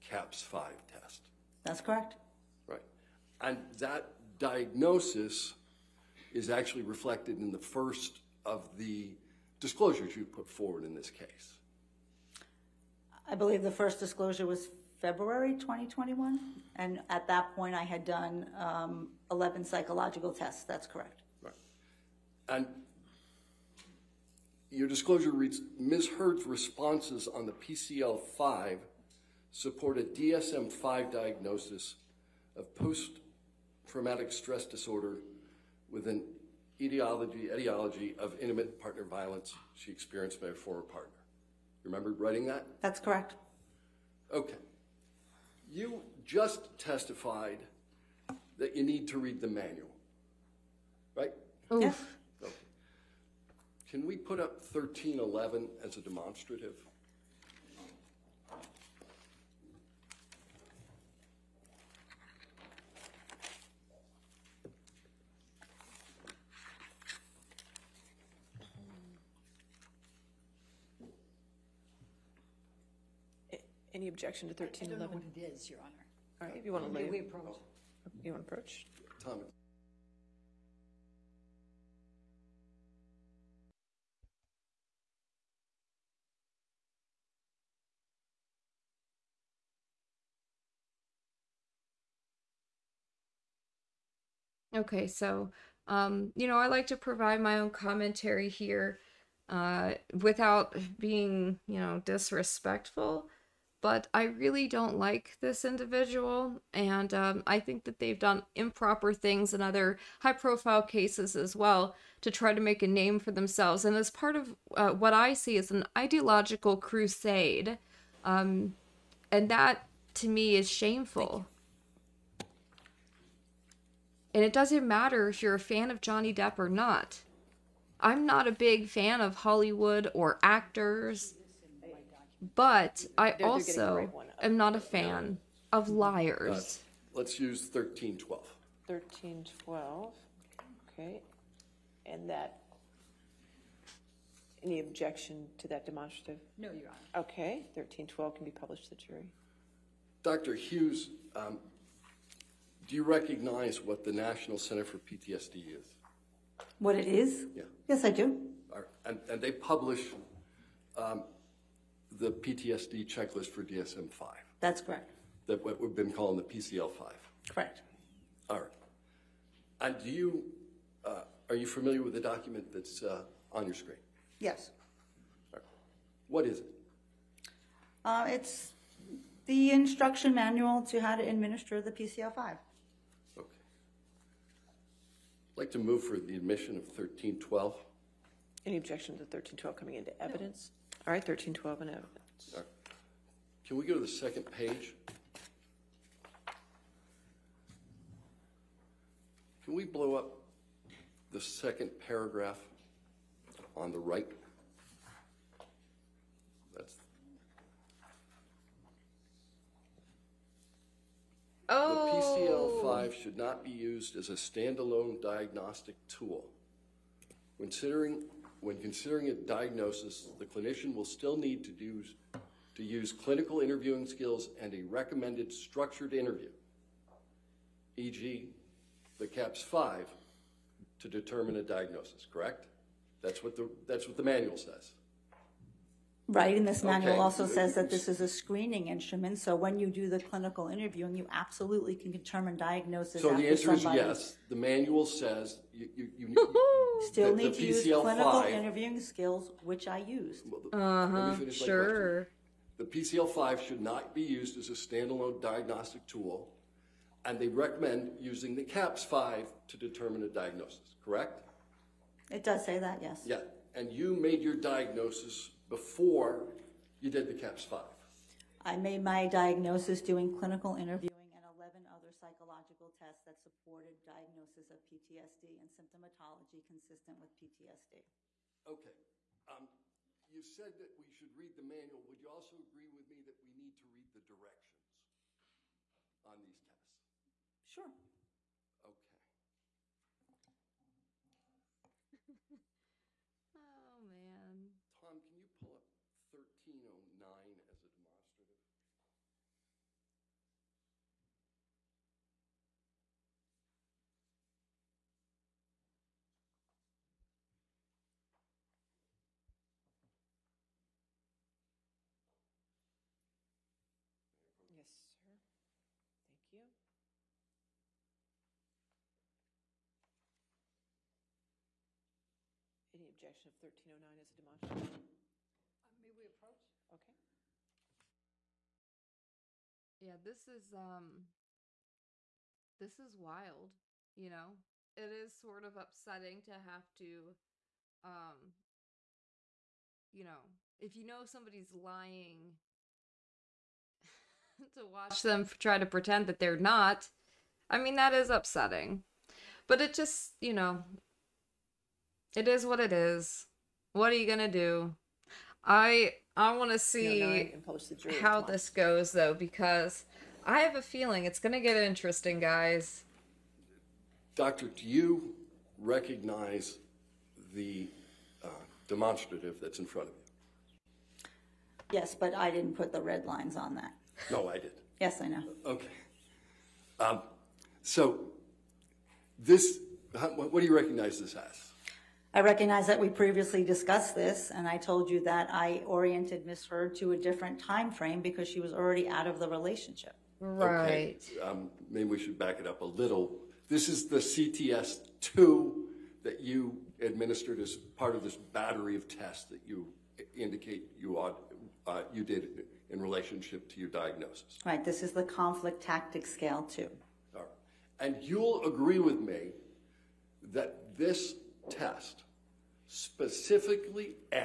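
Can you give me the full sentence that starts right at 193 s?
Can we go to the second page?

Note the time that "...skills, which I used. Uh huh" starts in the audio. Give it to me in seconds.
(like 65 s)
248 s.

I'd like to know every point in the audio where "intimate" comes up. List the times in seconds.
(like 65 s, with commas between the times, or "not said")
38 s.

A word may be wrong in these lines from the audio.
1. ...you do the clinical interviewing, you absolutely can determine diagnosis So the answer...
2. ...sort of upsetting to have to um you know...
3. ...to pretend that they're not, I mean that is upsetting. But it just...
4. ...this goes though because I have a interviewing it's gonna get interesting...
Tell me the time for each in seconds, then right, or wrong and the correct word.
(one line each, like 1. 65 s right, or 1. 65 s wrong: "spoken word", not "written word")
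1. 239 s right
2. 335 s right
3. 345 s right
4. 358 s wrong: "feeling", not "interviewing".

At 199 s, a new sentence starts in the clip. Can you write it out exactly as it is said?
Can we blow up the second paragraph on the right?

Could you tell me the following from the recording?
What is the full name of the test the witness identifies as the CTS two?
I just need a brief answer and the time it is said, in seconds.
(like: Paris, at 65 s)
Conflict Tactic Scale 2, at 405 s.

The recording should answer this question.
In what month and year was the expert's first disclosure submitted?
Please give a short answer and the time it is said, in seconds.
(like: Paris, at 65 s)
February 2021, at 15 s.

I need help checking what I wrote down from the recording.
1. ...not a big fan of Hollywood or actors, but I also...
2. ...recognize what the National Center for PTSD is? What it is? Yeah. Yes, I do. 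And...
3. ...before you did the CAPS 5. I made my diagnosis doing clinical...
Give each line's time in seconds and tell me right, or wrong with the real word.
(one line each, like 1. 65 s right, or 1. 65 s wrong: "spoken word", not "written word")
1. 128 s right
2. 153 s right
3. 265 s right.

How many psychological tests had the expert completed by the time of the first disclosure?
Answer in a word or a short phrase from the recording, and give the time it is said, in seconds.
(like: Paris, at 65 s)
11, at 18 s.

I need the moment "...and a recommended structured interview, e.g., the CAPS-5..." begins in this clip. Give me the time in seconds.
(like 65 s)
224 s.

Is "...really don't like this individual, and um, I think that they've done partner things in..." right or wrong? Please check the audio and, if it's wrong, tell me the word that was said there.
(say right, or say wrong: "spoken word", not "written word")
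wrong: "improper", not "partner".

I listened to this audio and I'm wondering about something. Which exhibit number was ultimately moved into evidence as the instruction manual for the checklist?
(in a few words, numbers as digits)
1312.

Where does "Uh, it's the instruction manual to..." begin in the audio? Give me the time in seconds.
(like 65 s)
178 s.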